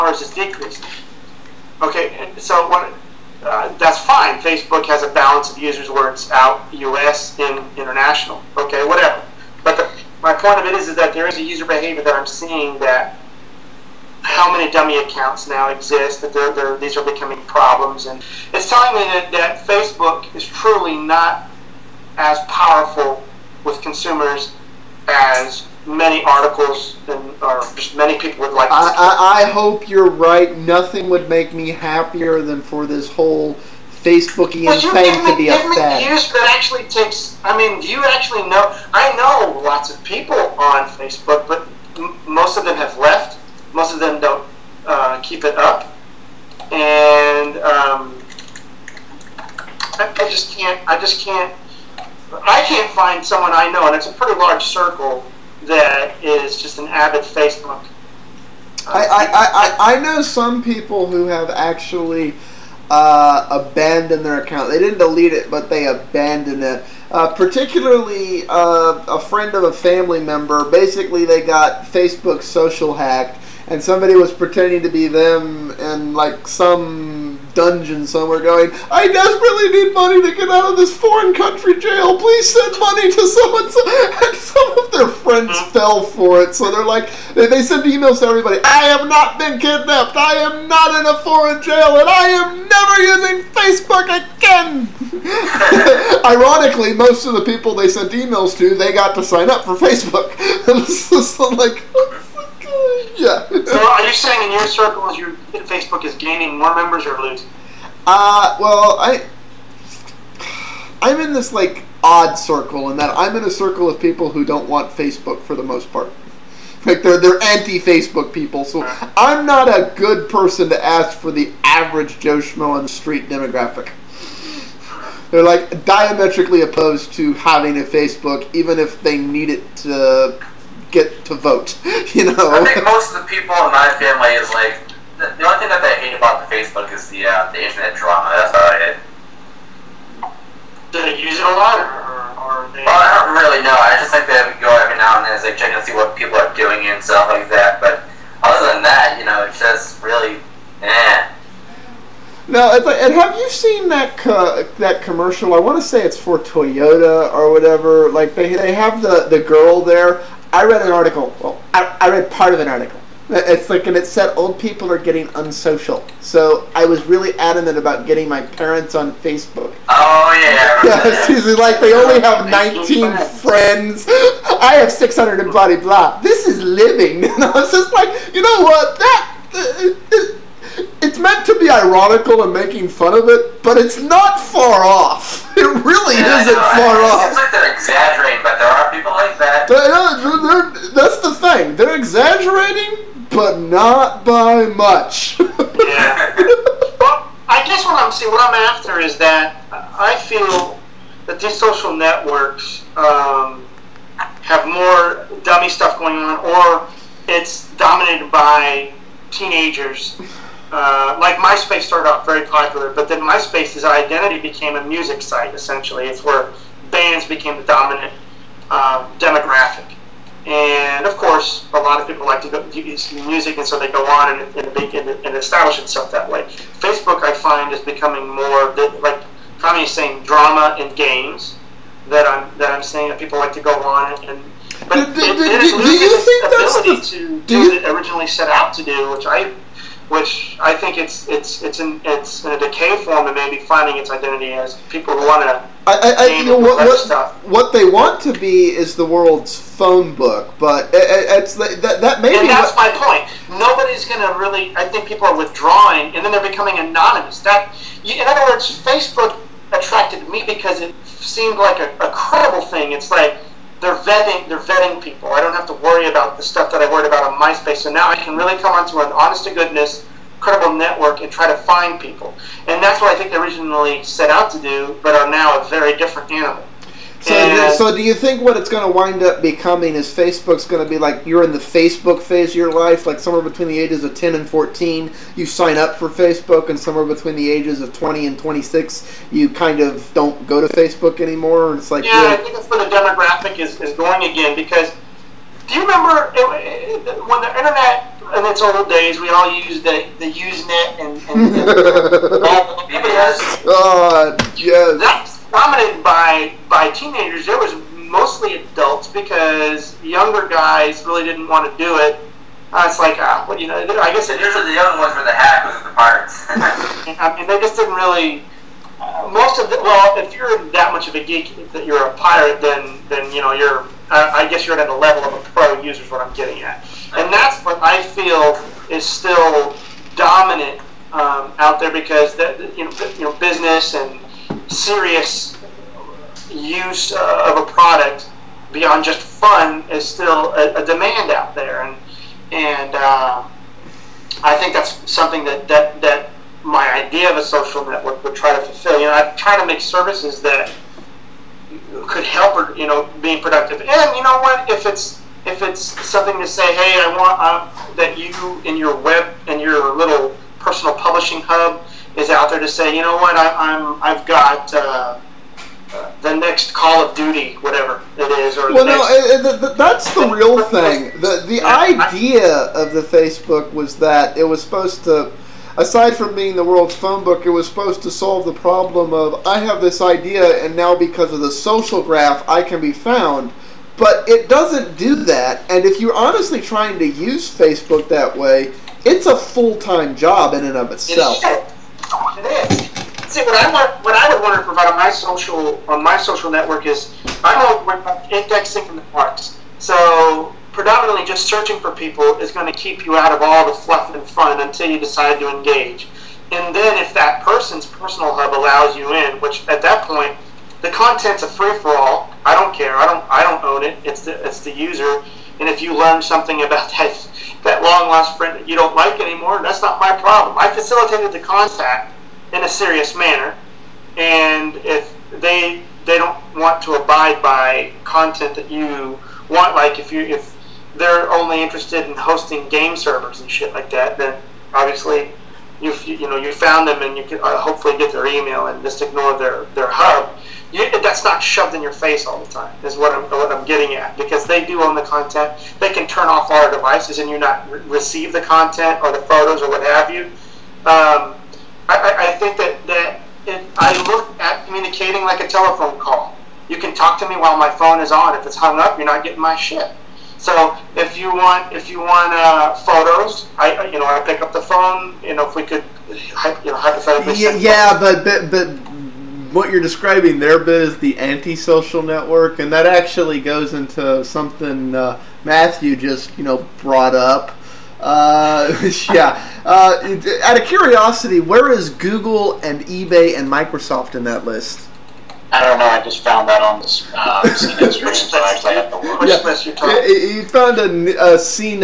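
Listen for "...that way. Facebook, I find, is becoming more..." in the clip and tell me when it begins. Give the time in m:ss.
3:46.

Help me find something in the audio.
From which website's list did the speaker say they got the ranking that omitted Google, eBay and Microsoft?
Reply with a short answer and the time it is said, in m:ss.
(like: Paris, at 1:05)
CNET, at 8:07.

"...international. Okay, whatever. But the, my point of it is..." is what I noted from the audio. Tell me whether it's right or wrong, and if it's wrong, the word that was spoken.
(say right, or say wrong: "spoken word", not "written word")
right.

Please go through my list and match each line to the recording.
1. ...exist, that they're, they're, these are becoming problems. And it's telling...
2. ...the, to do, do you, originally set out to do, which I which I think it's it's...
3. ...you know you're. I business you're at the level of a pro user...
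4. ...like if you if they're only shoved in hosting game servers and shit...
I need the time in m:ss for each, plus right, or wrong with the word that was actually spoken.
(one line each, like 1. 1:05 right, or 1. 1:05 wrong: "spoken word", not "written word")
1. 0:15 right
2. 3:57 right
3. 5:23 wrong: "guess", not "business"
4. 7:09 wrong: "interested", not "shoved".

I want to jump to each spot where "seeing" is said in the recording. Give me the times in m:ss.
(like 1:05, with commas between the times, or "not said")
0:12, 3:18.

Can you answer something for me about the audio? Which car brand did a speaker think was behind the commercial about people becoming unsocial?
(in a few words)
Toyota.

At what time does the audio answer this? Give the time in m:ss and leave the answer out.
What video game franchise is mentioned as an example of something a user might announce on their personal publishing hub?
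6:06.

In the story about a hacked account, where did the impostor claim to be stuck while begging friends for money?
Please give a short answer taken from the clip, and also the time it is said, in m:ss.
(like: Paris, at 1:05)
foreign country jail, at 1:20.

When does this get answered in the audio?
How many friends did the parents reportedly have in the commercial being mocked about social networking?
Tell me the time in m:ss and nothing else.
2:52.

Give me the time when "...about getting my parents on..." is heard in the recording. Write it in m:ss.
2:47.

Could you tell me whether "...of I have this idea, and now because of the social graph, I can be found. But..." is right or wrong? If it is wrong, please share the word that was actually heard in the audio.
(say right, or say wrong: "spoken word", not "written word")
right.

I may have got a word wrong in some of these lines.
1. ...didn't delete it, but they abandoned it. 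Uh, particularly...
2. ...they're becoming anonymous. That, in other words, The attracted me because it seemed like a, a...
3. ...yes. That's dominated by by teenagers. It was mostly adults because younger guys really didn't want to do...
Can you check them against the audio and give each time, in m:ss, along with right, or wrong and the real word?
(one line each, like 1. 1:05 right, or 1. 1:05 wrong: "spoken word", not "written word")
1. 1:04 right
2. 4:16 wrong: "Facebook", not "The"
3. 5:04 right.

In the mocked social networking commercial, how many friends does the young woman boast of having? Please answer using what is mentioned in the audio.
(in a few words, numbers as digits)
600.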